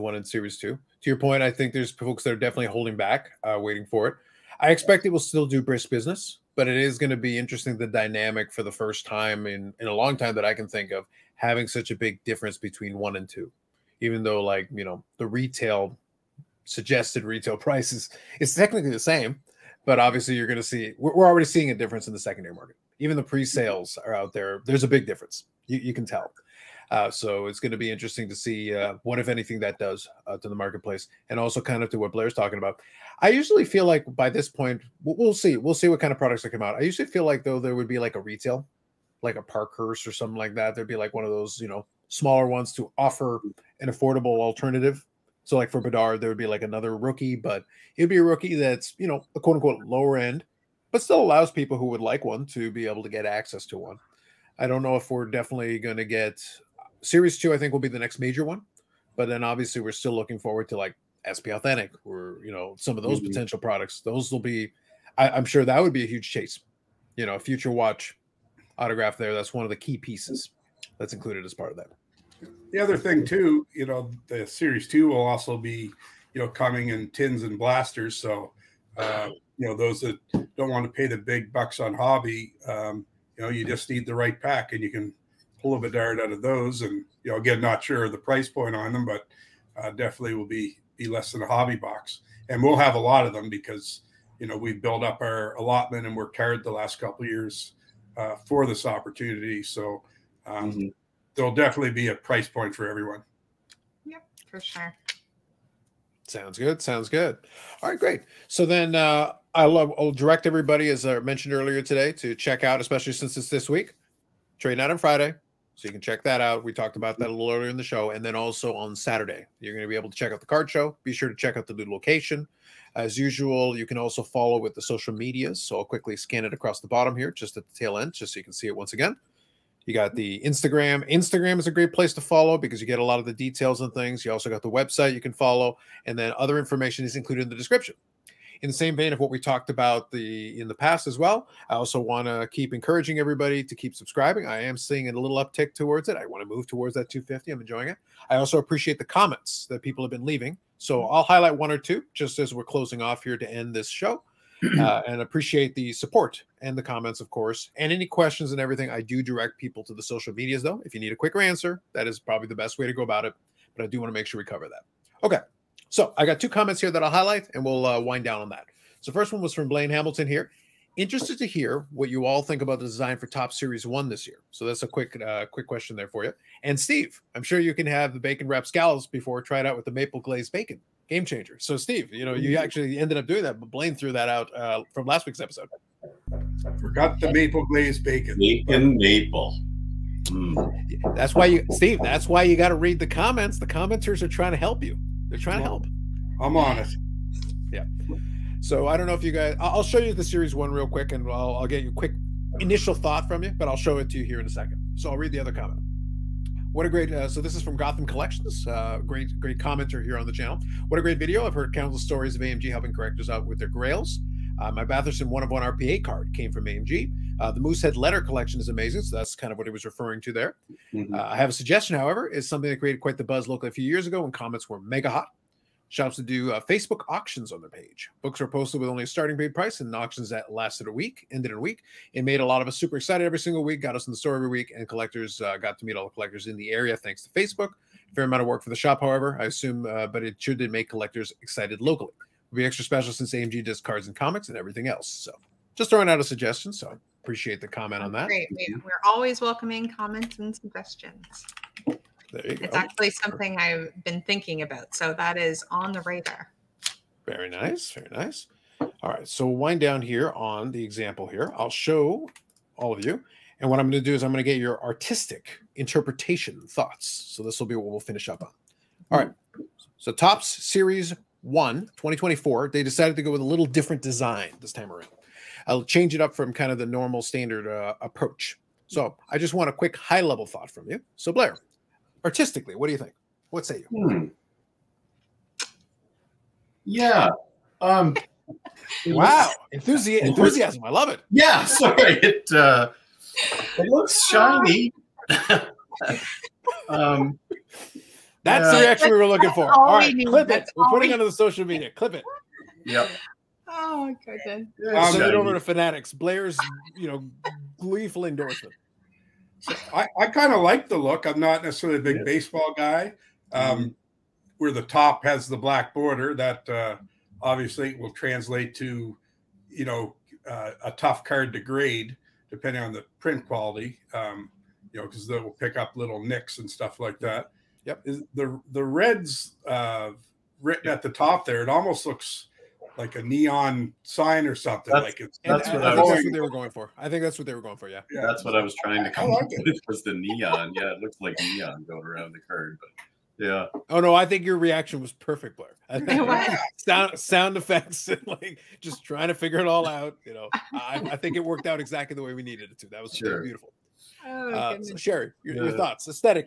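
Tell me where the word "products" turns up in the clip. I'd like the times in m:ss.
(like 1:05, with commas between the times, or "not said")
0:36, 1:03.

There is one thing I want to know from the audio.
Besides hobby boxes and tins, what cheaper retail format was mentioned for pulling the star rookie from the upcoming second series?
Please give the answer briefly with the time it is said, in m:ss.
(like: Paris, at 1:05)
blasters, at 1:17.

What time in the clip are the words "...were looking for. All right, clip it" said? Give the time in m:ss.
4:59.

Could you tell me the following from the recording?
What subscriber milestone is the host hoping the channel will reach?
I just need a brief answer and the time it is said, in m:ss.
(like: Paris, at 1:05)
250, at 2:27.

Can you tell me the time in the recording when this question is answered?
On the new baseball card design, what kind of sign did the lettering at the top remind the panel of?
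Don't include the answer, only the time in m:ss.
5:33.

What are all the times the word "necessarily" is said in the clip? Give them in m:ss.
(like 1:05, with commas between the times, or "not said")
5:11.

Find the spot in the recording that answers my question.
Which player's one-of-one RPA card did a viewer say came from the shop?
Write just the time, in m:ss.
3:34.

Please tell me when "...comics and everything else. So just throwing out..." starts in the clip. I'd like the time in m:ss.
4:04.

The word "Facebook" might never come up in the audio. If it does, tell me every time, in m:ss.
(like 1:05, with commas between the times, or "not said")
3:46, 3:57.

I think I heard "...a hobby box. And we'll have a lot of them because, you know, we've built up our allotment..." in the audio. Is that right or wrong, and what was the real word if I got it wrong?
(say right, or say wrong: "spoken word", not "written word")
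right.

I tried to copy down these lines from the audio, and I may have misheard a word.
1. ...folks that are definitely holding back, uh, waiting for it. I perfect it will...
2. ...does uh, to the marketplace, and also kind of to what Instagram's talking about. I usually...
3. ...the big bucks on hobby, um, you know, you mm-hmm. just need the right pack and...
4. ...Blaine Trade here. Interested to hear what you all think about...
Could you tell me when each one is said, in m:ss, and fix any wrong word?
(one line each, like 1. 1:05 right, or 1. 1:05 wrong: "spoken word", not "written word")
1. 0:01 wrong: "expect", not "perfect"
2. 0:29 wrong: "Blair", not "Instagram"
3. 1:21 right
4. 2:49 wrong: "Hamilton", not "Trade".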